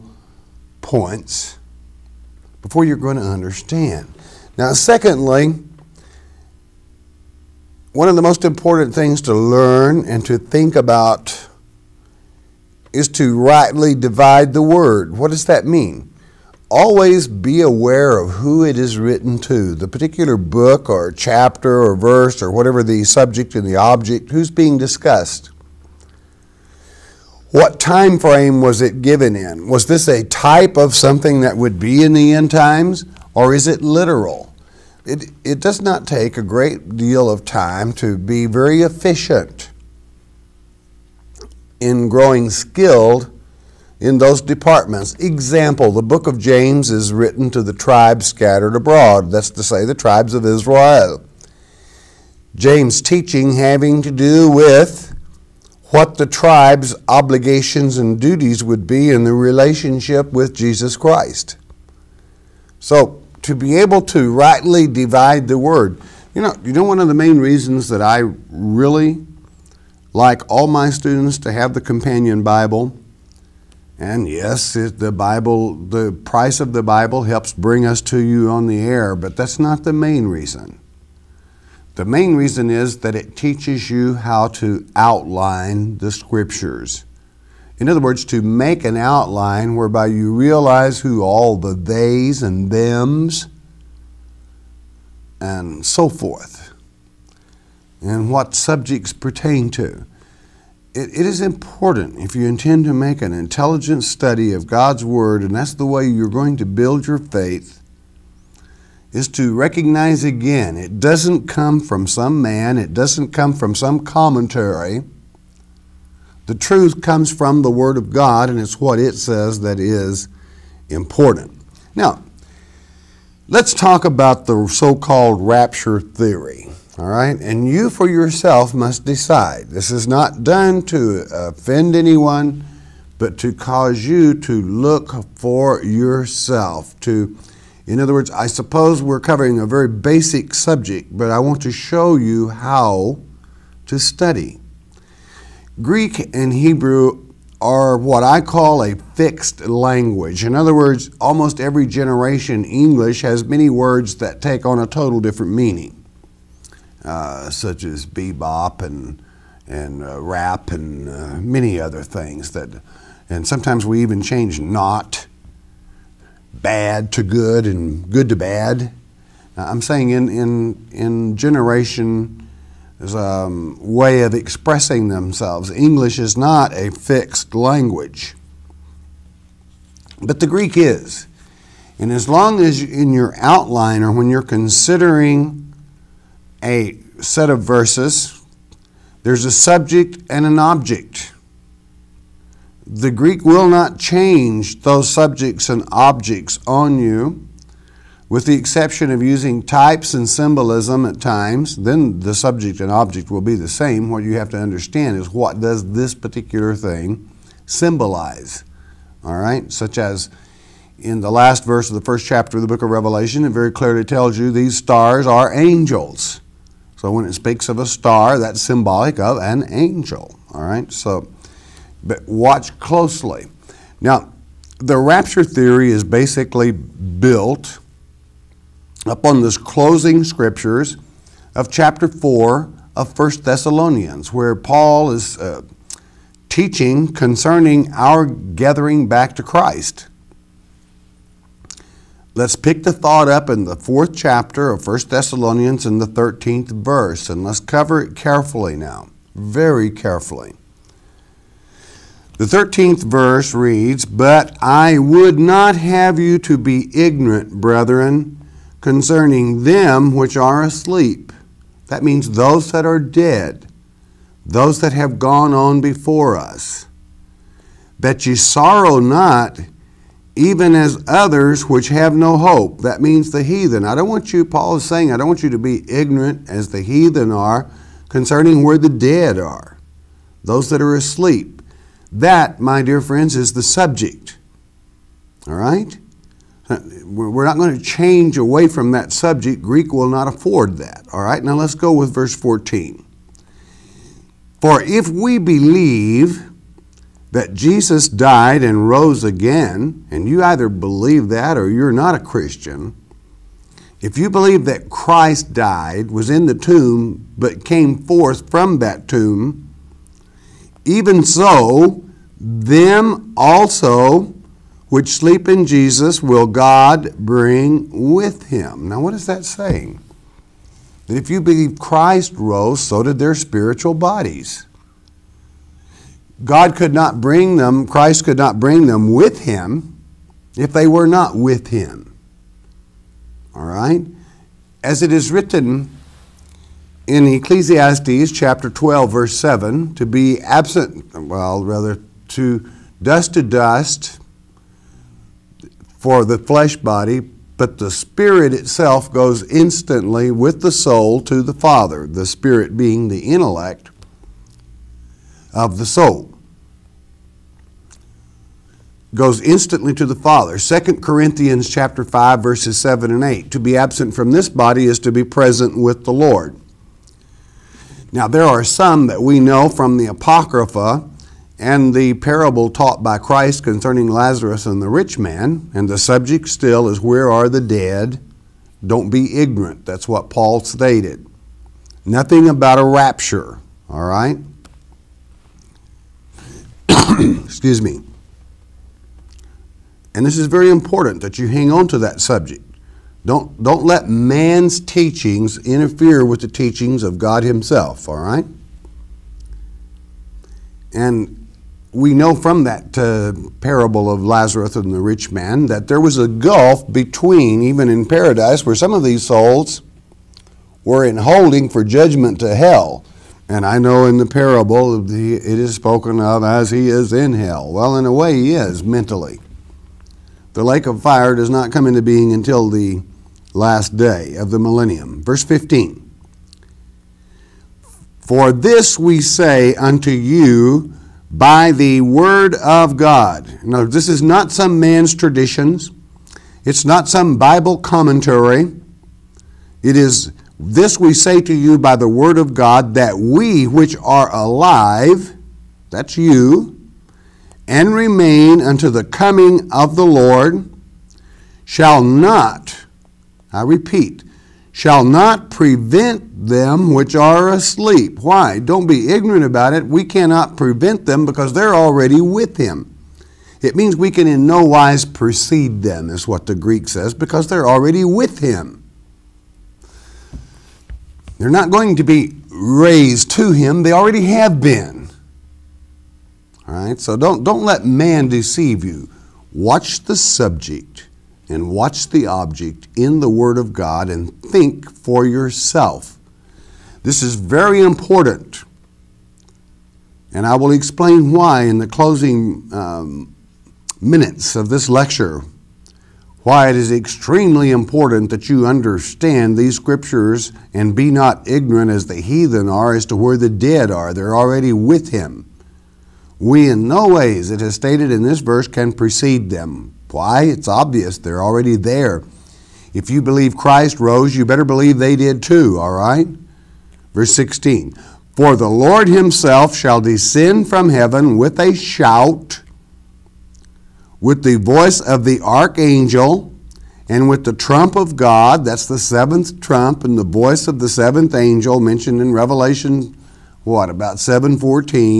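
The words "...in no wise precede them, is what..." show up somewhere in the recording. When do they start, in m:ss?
7:44.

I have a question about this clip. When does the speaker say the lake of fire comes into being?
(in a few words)
The last day of the millennium.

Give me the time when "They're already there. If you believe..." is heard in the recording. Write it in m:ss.
8:31.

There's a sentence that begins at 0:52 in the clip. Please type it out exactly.
James' teaching having to do with what the tribe's obligations and duties would be in the relationship with Jesus Christ.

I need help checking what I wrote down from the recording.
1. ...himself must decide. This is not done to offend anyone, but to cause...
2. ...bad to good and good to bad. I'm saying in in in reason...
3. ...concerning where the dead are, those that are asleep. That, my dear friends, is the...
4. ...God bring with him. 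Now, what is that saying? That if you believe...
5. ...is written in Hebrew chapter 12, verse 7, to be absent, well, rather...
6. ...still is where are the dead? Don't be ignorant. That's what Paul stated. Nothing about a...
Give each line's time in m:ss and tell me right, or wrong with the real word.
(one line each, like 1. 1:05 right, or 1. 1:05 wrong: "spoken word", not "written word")
1. 2:08 wrong: "yourself", not "himself"
2. 2:46 wrong: "generation", not "reason"
3. 4:38 right
4. 5:16 right
5. 5:35 wrong: "Ecclesiastes", not "Hebrew"
6. 6:16 right.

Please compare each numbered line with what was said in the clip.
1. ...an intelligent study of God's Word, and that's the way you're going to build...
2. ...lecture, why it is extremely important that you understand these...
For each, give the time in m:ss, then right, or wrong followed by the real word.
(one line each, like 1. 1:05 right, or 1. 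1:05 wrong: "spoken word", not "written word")
1. 1:43 right
2. 8:14 right.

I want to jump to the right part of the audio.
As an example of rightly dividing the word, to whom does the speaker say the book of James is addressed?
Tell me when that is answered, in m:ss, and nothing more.
0:47.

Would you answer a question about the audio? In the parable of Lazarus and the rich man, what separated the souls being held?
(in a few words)
A gulf.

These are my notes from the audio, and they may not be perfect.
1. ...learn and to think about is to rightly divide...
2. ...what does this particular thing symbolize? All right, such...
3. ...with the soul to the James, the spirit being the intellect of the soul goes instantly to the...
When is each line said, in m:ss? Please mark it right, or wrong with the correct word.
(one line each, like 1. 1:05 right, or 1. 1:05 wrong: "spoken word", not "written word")
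1. 0:09 right
2. 3:25 right
3. 5:50 wrong: "Father", not "James".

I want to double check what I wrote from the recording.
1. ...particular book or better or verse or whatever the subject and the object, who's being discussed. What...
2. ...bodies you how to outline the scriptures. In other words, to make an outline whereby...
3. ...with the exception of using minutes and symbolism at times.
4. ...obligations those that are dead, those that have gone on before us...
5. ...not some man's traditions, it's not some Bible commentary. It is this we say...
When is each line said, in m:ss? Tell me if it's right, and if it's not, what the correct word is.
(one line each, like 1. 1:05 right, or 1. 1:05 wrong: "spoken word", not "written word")
1. 0:19 wrong: "chapter", not "better"
2. 1:23 wrong: "teaches", not "bodies"
3. 3:18 wrong: "types", not "minutes"
4. 4:22 wrong: "means", not "obligations"
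5. 7:14 right.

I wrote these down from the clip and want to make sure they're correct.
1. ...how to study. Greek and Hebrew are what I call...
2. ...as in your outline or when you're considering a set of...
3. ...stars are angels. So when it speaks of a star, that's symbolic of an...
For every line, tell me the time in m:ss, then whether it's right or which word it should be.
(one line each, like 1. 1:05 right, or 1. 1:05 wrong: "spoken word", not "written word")
1. 2:22 right
2. 3:02 right
3. 3:34 right.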